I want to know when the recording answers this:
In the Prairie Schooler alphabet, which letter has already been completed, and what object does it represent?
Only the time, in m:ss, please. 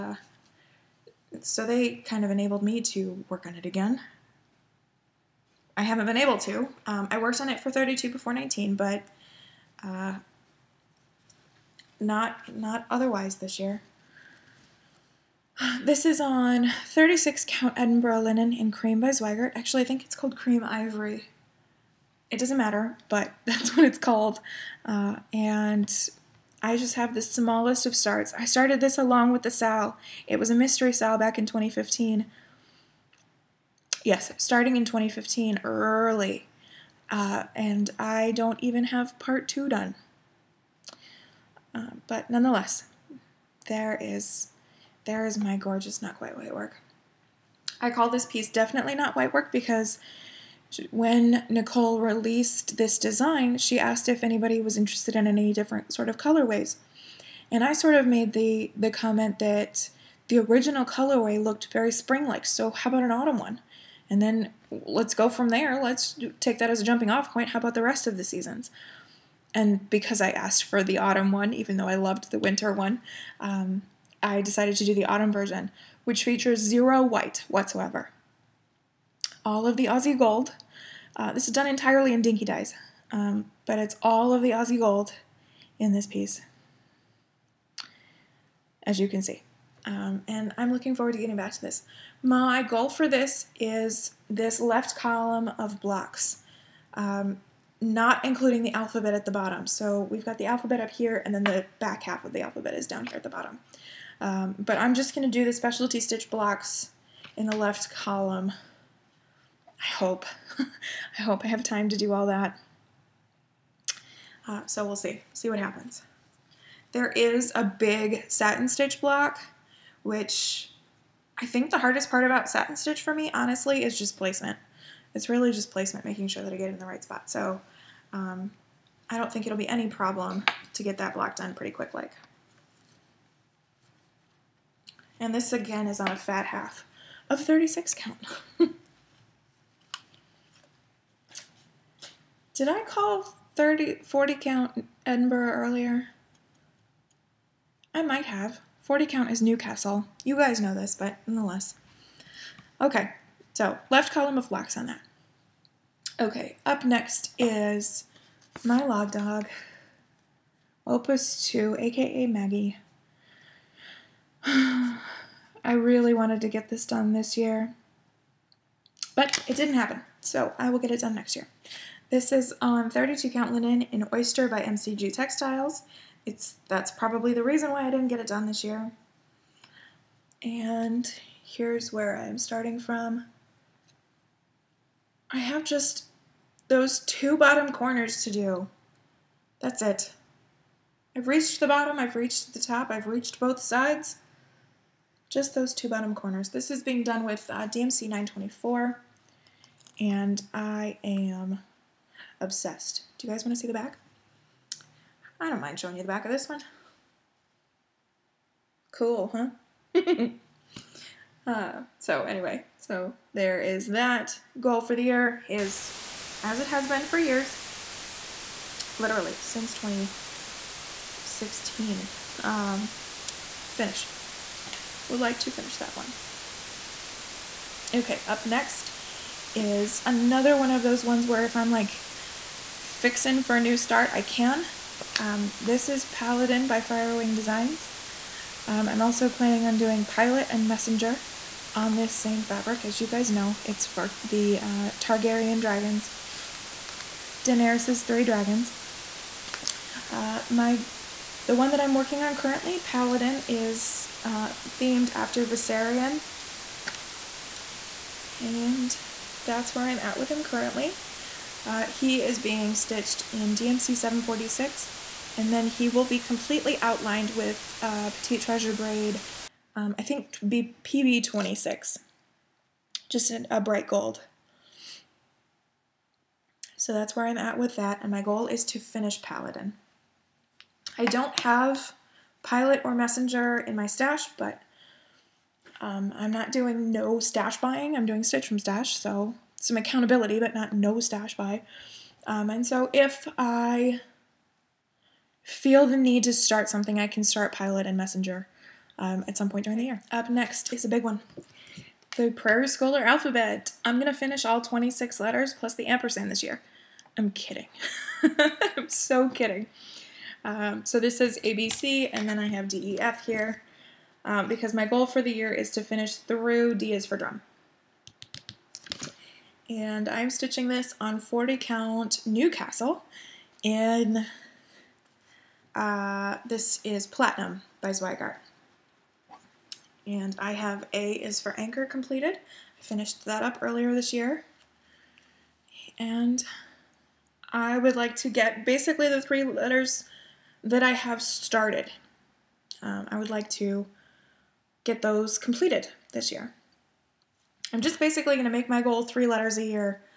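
5:30.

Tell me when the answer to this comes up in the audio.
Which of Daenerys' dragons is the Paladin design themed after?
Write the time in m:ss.
4:15.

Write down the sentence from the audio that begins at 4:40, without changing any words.
I don't have Pilot or Messenger in my stash, but um, I'm not doing no stash buying.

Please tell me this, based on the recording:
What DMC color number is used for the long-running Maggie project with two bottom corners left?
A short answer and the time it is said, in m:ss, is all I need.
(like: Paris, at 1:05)
924, at 3:17.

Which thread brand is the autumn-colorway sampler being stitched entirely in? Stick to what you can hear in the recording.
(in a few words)
Dinky Dyes.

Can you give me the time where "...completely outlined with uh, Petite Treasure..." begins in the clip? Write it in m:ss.
4:26.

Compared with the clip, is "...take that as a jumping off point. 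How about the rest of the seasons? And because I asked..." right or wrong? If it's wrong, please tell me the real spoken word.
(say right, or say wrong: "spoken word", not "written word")
right.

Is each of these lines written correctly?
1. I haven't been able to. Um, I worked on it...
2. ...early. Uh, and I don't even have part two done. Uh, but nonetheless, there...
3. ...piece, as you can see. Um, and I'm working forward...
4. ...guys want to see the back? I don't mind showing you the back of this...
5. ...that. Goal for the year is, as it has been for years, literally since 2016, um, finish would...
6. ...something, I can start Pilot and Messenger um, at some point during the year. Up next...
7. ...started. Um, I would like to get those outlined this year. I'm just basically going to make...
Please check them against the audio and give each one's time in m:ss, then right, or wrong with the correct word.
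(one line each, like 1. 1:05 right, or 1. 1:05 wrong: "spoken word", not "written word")
1. 0:05 right
2. 0:35 right
3. 1:26 wrong: "looking", not "working"
4. 3:23 right
5. 3:33 right
6. 4:56 right
7. 5:41 wrong: "completed", not "outlined".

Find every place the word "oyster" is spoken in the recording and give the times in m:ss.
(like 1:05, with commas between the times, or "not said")
2:54.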